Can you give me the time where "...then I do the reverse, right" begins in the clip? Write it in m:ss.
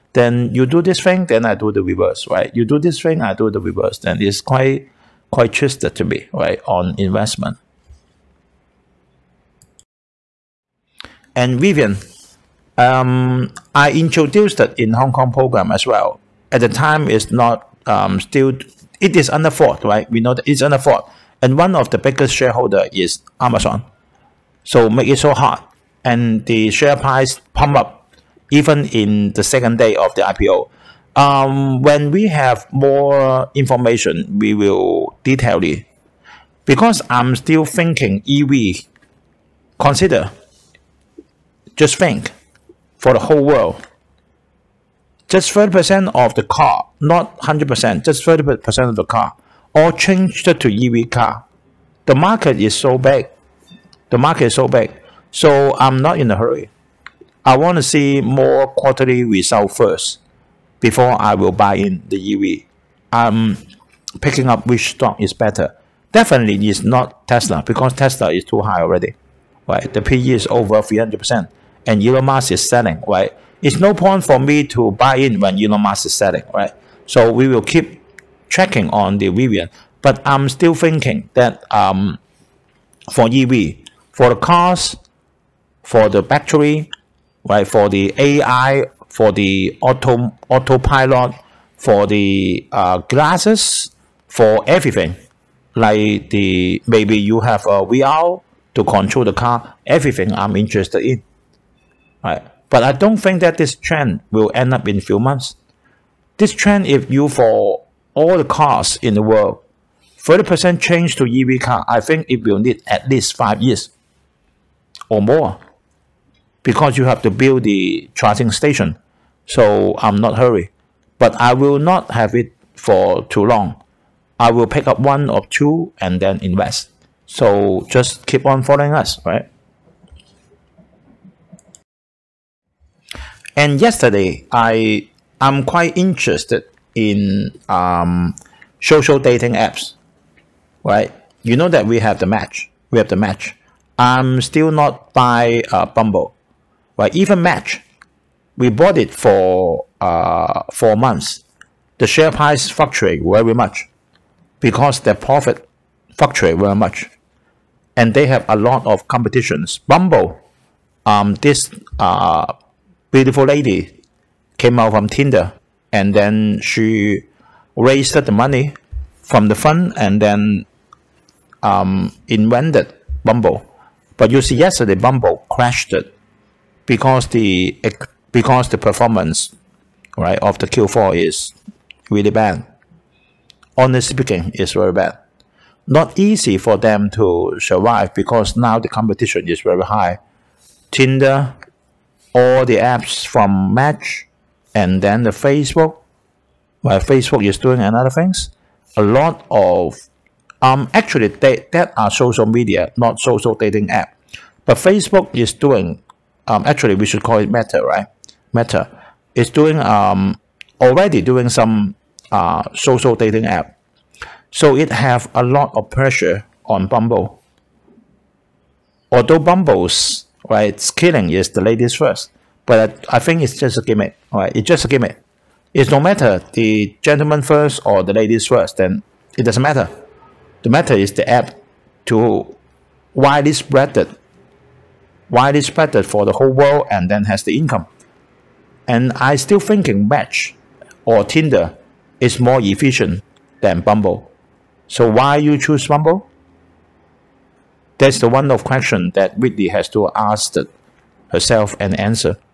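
0:01.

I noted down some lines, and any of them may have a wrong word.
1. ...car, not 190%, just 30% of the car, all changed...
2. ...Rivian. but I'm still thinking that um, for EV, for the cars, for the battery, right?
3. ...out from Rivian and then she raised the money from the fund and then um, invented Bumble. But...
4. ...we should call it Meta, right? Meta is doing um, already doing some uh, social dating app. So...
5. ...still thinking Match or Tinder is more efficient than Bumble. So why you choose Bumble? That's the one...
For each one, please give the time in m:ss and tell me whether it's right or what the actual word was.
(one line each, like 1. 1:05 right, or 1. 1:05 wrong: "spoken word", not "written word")
1. 0:46 wrong: "100", not "190"
2. 1:19 right
3. 2:44 wrong: "Tinder", not "Rivian"
4. 3:26 right
5. 3:59 right.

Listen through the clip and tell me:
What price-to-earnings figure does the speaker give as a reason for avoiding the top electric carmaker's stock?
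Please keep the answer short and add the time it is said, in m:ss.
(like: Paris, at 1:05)
300%, at 1:10.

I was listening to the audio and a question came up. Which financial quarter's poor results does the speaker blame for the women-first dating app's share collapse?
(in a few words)
Q4.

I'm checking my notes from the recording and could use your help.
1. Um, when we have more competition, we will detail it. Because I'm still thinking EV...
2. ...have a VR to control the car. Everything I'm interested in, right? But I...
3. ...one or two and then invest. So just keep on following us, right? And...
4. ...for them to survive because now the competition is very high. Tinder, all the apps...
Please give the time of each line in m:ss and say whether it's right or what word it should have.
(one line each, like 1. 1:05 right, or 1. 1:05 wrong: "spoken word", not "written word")
1. 0:31 wrong: "information", not "competition"
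2. 1:37 right
3. 2:04 right
4. 3:06 right.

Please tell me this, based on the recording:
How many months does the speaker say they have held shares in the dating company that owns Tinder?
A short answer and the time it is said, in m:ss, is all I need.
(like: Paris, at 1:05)
4, at 2:30.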